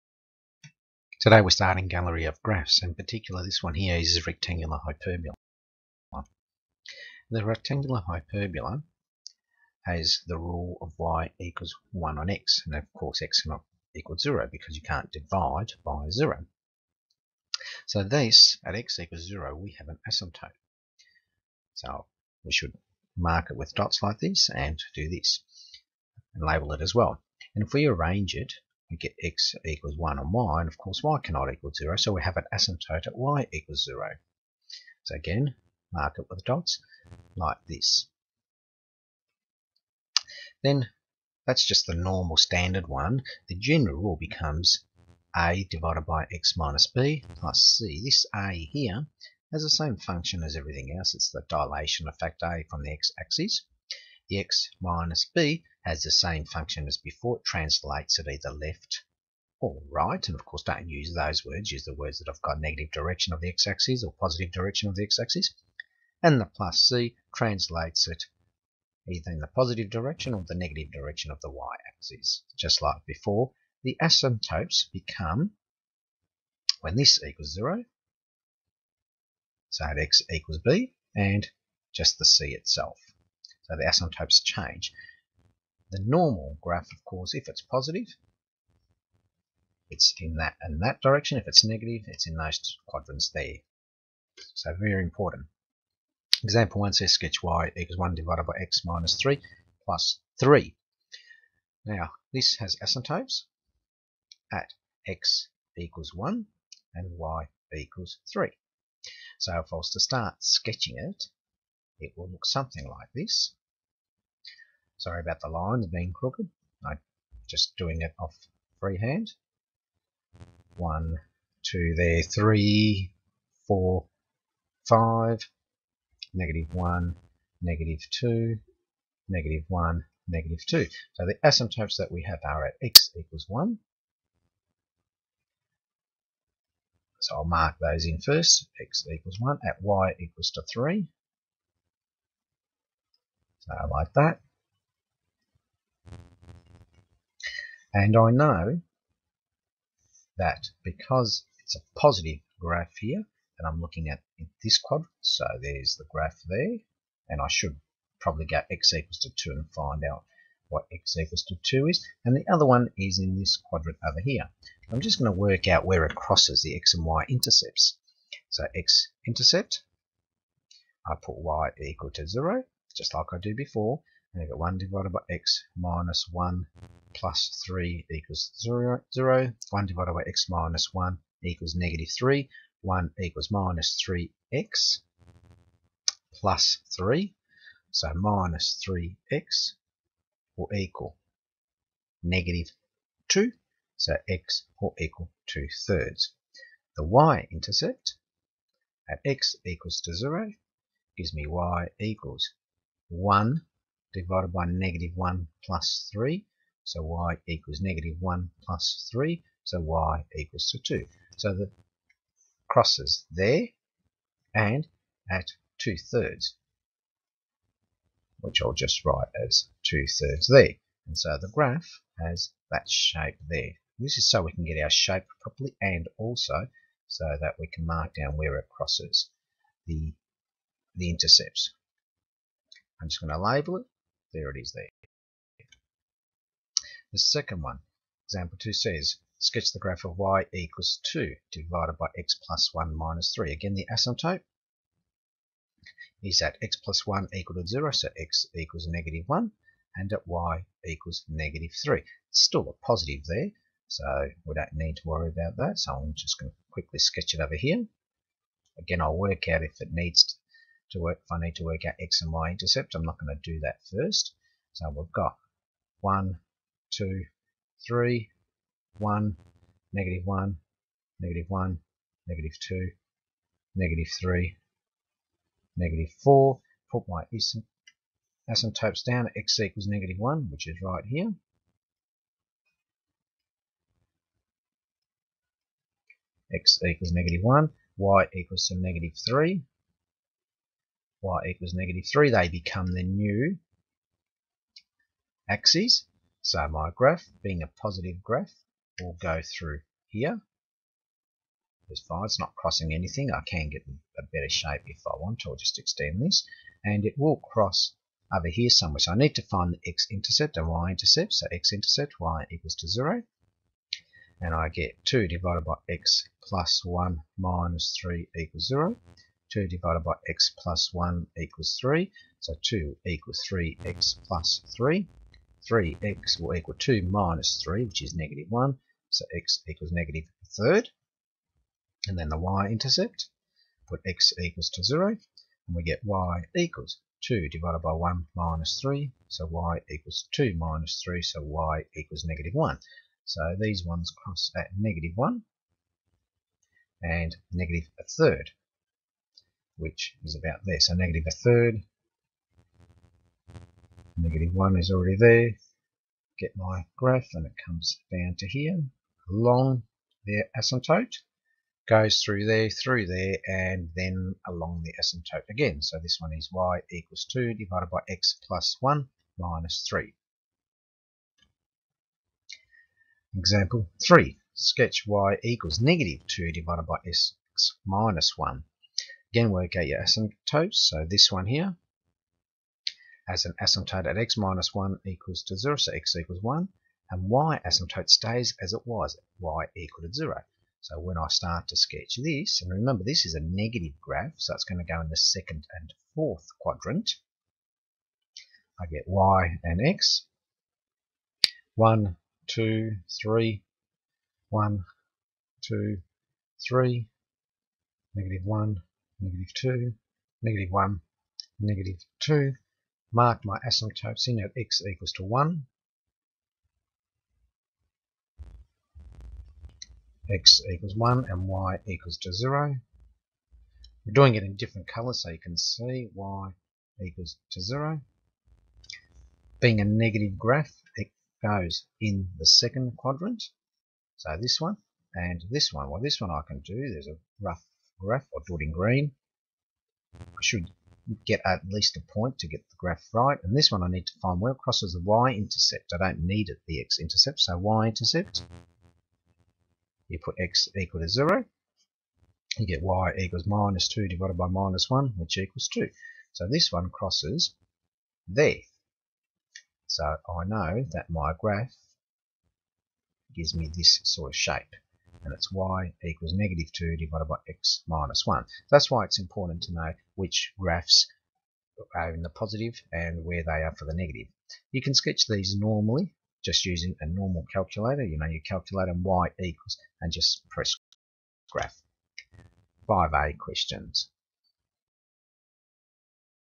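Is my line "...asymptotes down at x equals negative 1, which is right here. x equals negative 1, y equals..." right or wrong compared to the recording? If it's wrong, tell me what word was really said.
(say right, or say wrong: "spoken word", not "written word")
right.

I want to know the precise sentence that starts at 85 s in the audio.
The normal graph, of course, if it's positive, it's in that and that direction.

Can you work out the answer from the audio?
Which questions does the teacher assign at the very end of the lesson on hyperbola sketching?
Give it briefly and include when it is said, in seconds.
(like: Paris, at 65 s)
5a questions, at 482 s.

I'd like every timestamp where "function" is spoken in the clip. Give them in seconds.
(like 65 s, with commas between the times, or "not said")
49 s, 56 s.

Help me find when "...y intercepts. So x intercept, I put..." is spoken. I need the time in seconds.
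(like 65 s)
167 s.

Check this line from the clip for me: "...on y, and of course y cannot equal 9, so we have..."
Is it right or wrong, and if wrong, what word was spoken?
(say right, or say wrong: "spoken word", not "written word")
wrong: "0", not "9".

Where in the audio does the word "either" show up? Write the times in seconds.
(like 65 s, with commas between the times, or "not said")
58 s, 69 s.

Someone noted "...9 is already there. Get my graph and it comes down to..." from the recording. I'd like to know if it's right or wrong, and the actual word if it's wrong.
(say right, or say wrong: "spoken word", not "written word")
wrong: "1", not "9".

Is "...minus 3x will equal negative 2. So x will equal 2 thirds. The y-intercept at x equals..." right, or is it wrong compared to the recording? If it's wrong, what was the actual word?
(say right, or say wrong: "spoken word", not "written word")
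right.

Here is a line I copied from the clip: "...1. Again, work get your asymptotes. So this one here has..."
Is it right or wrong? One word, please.
right.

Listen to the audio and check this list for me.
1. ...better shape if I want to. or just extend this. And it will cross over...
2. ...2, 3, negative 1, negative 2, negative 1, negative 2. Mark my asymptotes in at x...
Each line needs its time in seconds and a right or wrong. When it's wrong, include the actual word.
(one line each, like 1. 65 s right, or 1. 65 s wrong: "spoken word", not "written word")
1. 304 s right
2. 405 s right.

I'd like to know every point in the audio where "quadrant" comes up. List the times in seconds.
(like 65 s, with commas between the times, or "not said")
92 s, 154 s, 163 s, 396 s, 432 s.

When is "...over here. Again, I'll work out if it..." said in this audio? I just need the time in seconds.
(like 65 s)
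257 s.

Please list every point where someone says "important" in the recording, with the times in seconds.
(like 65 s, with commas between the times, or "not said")
95 s, 469 s.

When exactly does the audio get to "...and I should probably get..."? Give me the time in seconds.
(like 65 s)
157 s.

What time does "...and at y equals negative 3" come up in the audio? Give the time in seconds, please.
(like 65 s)
249 s.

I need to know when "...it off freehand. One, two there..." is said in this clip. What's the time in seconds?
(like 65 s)
118 s.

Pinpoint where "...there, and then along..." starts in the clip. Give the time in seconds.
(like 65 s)
363 s.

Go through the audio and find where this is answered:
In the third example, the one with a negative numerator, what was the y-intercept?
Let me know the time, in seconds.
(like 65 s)
455 s.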